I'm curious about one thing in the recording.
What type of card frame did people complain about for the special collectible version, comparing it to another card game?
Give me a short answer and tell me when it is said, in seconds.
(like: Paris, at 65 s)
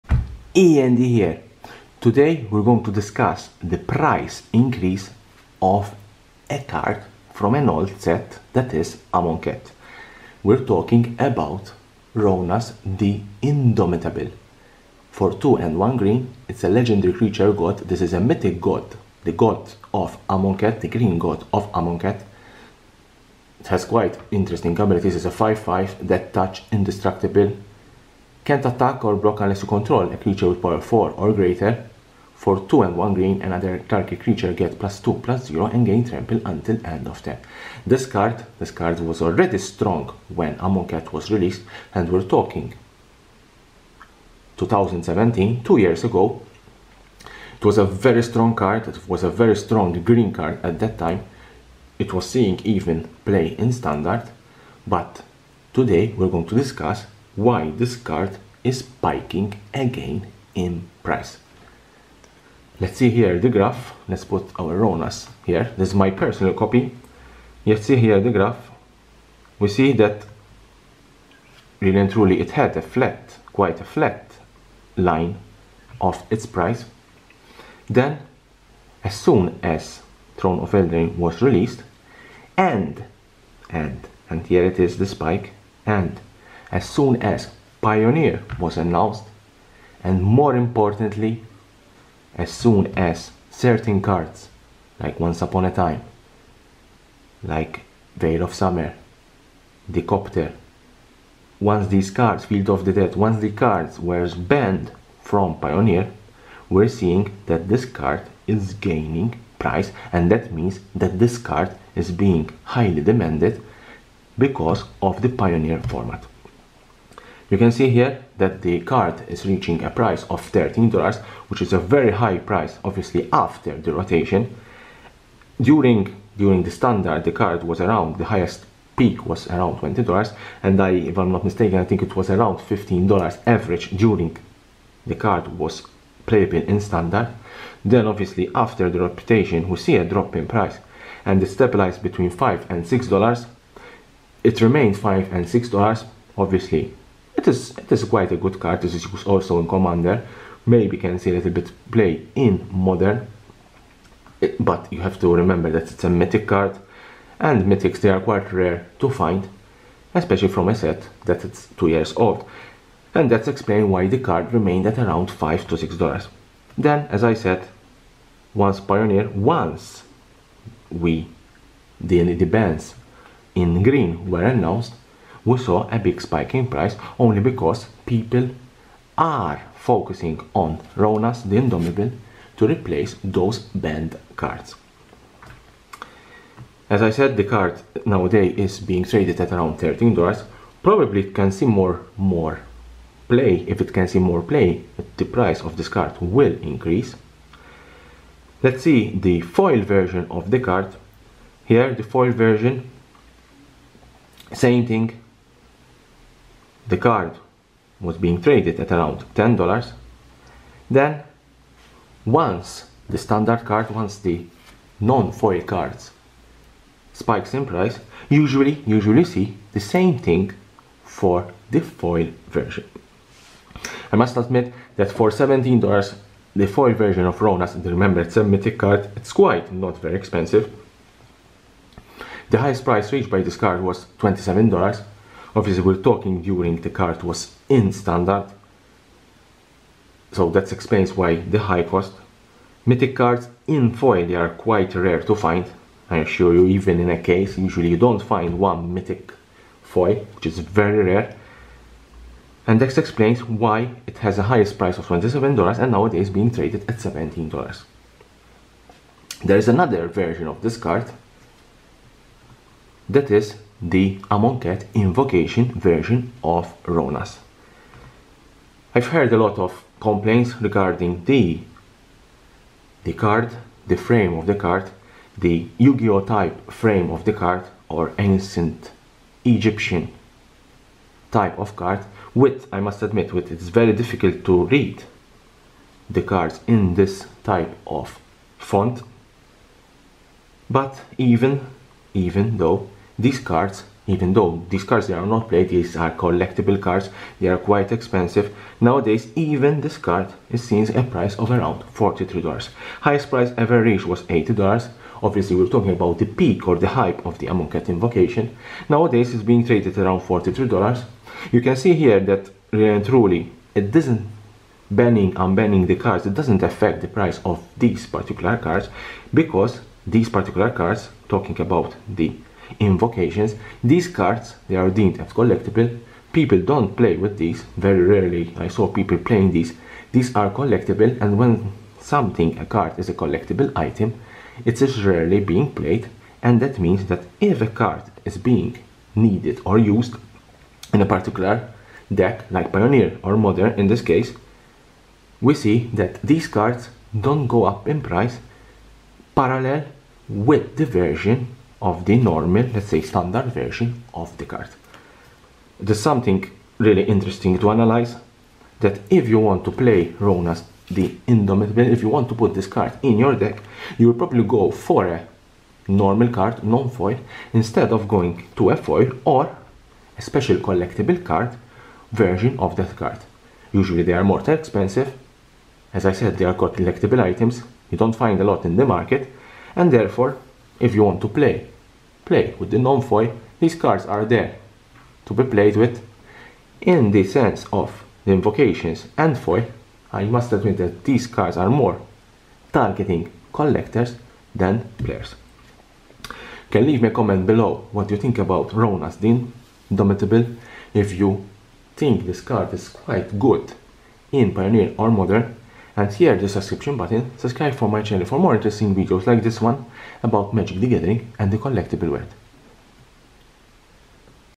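Yu-Gi-Oh type frame, at 275 s.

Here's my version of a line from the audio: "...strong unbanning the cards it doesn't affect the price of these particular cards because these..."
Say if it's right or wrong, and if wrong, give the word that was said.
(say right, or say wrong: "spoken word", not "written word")
wrong: "banning", not "strong".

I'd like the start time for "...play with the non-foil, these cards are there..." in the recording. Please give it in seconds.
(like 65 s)
382 s.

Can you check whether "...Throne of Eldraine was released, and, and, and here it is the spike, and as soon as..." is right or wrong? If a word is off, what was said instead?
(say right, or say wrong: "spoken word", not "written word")
right.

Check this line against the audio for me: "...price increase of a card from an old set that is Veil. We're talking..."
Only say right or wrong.
wrong.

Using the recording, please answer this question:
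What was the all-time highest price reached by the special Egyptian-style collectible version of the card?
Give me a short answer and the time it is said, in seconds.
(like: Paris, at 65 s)
$80, at 304 s.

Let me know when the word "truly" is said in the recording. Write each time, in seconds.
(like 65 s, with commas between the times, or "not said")
72 s, 313 s.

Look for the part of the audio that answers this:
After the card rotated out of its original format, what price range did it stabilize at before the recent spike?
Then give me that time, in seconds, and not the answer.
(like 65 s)
142 s.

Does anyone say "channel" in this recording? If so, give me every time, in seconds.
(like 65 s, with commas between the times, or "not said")
408 s.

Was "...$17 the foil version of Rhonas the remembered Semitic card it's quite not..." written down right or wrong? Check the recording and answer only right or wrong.
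right.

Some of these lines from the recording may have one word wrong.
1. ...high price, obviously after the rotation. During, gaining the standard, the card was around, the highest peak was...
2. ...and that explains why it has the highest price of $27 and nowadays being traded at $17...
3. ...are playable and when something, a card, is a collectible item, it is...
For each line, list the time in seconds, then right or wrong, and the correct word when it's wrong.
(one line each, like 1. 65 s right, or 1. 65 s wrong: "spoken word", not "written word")
1. 122 s wrong: "during", not "gaining"
2. 252 s right
3. 330 s wrong: "collectible", not "playable".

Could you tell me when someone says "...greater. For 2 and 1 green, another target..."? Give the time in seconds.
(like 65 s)
31 s.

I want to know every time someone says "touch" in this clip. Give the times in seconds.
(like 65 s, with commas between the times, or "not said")
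26 s.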